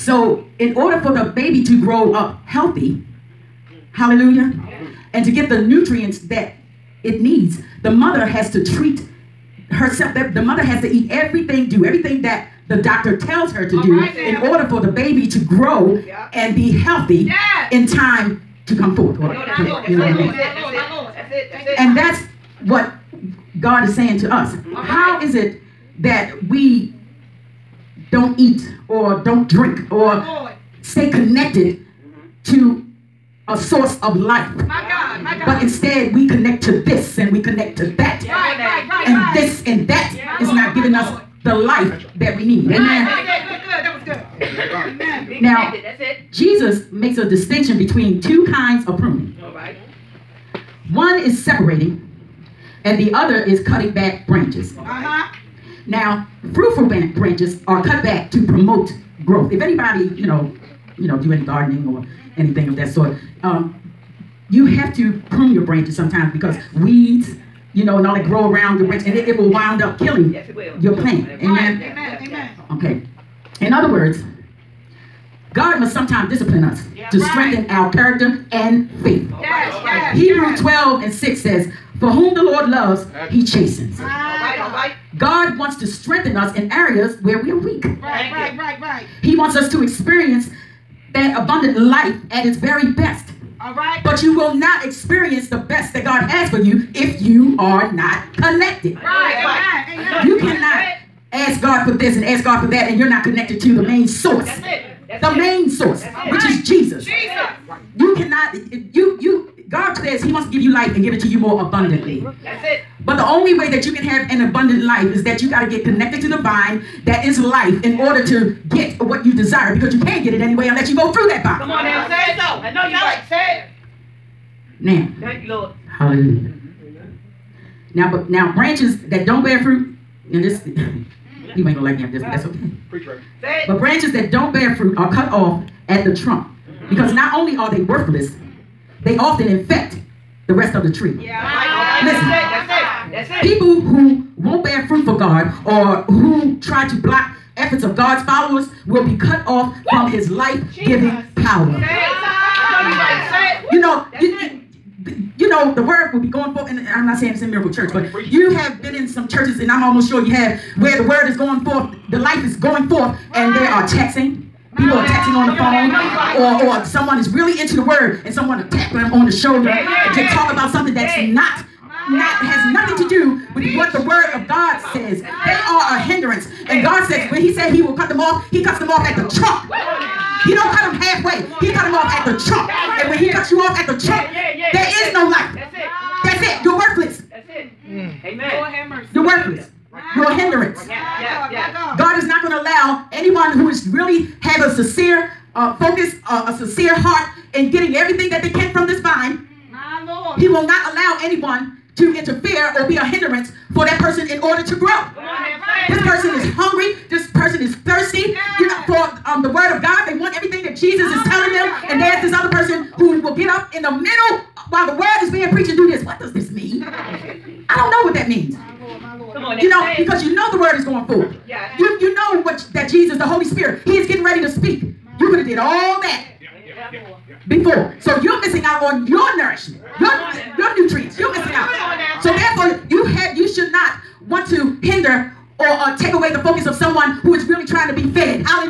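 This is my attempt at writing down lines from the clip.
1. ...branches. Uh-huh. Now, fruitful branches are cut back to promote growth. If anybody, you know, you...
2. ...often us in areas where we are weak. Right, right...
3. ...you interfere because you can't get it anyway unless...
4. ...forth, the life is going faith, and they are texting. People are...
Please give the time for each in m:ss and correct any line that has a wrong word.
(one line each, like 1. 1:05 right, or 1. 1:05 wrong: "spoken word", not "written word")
1. 0:54 right
2. 1:25 wrong: "strengthen", not "often"
3. 1:59 wrong: "desire", not "interfere"
4. 2:41 wrong: "forth", not "faith".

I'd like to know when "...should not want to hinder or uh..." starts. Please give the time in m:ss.
3:53.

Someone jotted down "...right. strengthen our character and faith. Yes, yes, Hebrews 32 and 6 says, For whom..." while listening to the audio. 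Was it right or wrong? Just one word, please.
wrong.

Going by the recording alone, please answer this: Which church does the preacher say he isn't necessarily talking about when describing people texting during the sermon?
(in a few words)
Miracle Church.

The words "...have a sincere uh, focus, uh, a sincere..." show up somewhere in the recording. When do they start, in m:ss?
3:14.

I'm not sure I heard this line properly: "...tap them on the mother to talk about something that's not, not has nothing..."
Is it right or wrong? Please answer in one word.
wrong.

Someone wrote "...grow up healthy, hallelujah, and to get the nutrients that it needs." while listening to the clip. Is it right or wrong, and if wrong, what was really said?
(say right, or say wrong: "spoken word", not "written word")
right.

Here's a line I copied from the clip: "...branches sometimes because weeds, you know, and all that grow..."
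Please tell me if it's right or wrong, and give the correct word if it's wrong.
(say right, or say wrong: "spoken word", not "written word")
right.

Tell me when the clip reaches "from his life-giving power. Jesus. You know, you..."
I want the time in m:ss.
2:29.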